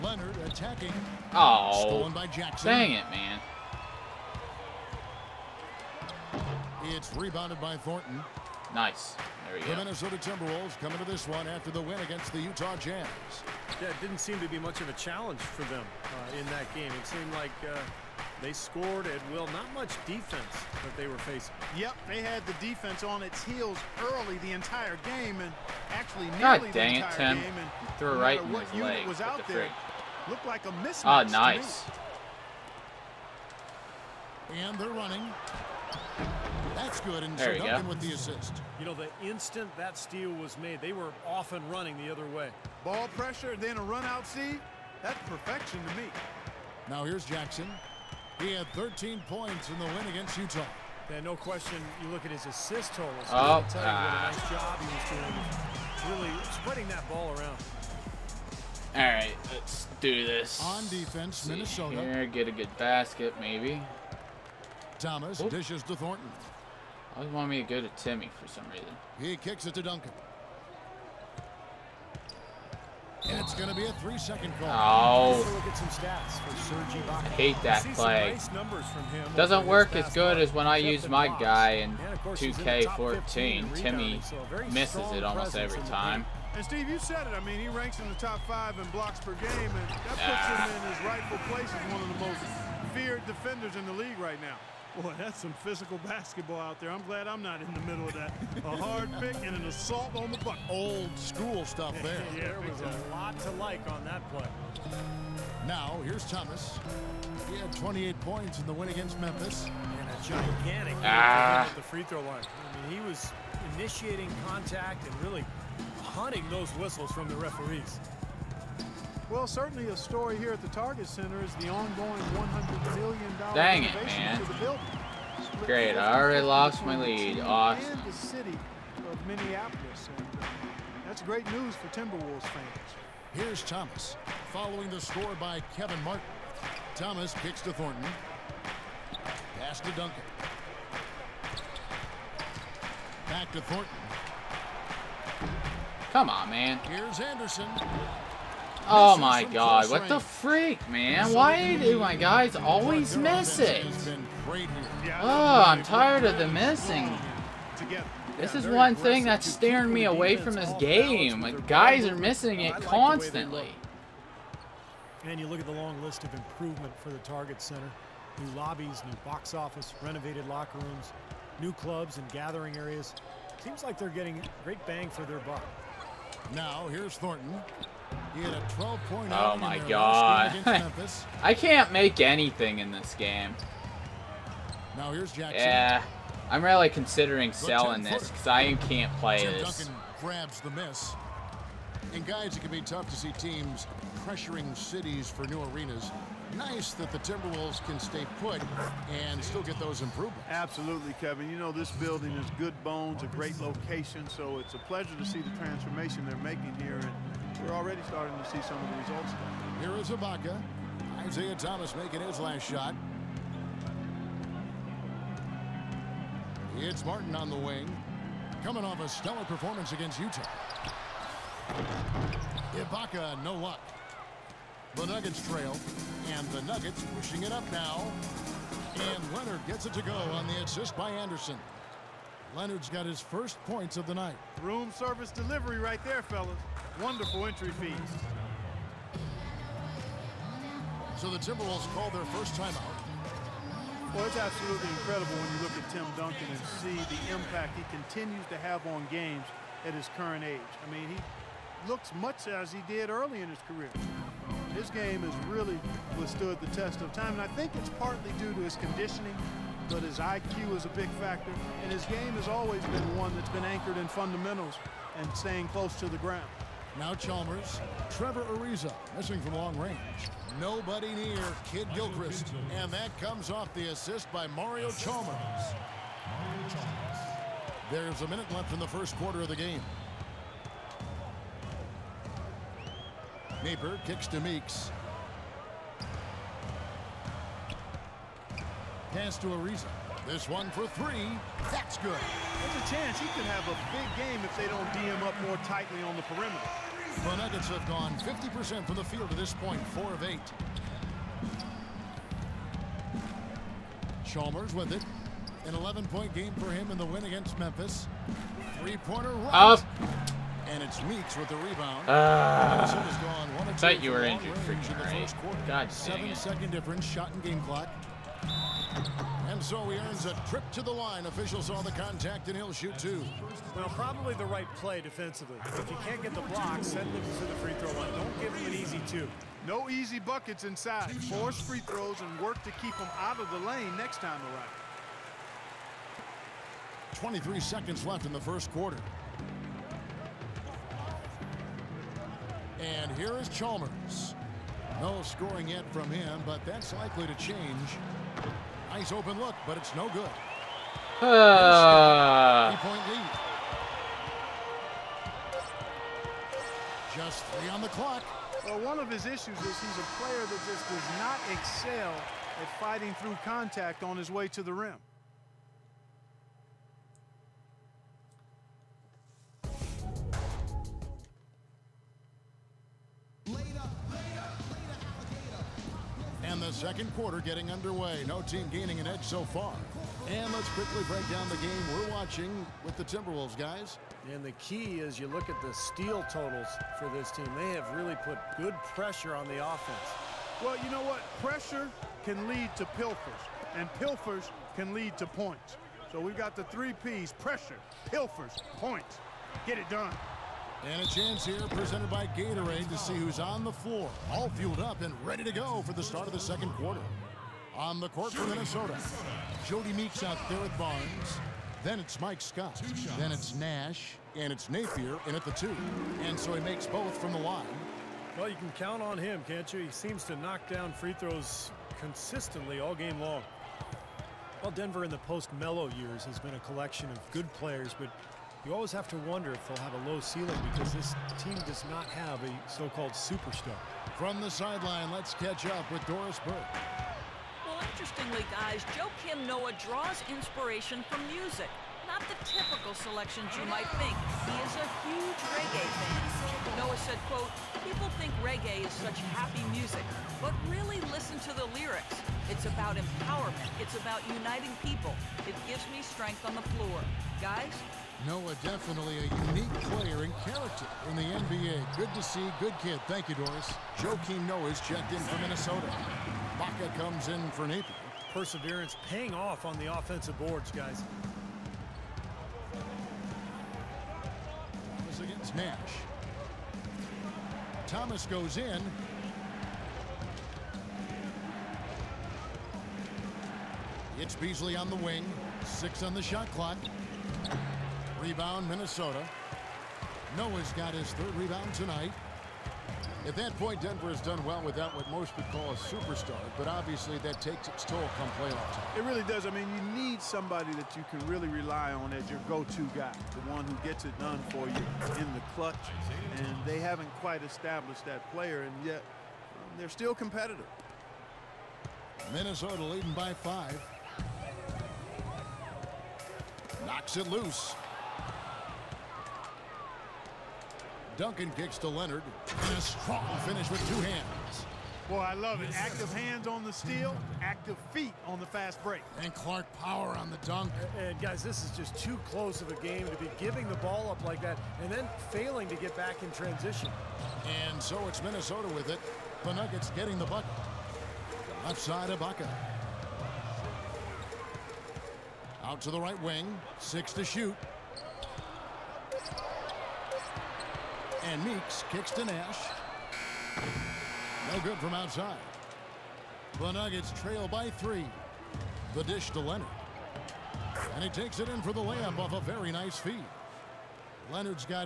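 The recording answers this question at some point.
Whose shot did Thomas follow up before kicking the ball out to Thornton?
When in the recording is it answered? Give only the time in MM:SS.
02:15.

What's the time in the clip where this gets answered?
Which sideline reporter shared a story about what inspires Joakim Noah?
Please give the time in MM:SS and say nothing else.
07:16.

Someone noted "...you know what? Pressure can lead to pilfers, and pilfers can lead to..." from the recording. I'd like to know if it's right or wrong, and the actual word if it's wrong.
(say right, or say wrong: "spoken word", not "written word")
right.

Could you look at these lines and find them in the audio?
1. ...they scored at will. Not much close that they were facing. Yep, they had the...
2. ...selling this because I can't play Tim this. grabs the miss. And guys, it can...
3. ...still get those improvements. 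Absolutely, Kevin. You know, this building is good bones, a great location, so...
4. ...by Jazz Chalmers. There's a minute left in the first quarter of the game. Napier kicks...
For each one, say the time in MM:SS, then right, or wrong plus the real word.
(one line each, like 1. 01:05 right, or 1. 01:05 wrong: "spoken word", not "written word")
1. 00:18 wrong: "defense", not "close"
2. 03:07 right
3. 03:19 right
4. 04:34 wrong: "Mario", not "Jazz".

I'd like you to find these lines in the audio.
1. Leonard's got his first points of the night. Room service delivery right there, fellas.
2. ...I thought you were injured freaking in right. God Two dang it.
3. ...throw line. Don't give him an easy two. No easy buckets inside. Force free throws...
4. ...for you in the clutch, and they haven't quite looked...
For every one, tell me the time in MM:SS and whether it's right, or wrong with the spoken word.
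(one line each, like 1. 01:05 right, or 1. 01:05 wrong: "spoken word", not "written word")
1. 03:52 right
2. 05:12 wrong: "Seven", not "Two"
3. 05:27 right
4. 08:24 wrong: "established", not "looked".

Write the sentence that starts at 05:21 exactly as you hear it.
Officials saw the contact, and he'll shoot two.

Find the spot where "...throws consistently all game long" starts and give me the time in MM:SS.
07:01.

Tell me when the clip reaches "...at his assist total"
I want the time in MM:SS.
00:52.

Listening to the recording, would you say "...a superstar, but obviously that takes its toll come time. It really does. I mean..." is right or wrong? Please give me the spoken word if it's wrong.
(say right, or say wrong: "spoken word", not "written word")
right.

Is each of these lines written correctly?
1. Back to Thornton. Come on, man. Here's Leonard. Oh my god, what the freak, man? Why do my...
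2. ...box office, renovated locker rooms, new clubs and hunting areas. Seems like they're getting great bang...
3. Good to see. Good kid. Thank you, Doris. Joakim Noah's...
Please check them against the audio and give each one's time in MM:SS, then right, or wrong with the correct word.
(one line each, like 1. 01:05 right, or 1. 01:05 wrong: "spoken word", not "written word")
1. 02:23 wrong: "Anderson", not "Leonard"
2. 02:49 wrong: "gathering", not "hunting"
3. 07:41 right.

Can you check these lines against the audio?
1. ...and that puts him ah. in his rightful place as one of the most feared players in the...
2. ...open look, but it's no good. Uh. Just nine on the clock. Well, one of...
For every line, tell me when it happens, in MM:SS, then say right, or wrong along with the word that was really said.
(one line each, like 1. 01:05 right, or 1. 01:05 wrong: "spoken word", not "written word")
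1. 01:29 wrong: "defenders", not "players"
2. 05:49 wrong: "three", not "nine".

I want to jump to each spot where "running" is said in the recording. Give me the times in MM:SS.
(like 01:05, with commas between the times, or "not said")
00:34, 00:41.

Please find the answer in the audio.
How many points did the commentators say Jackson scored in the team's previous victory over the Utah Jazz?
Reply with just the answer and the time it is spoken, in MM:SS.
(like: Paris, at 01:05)
13, at 00:48.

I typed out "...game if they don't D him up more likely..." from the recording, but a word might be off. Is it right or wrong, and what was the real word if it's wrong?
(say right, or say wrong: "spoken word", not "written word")
wrong: "tightly", not "likely".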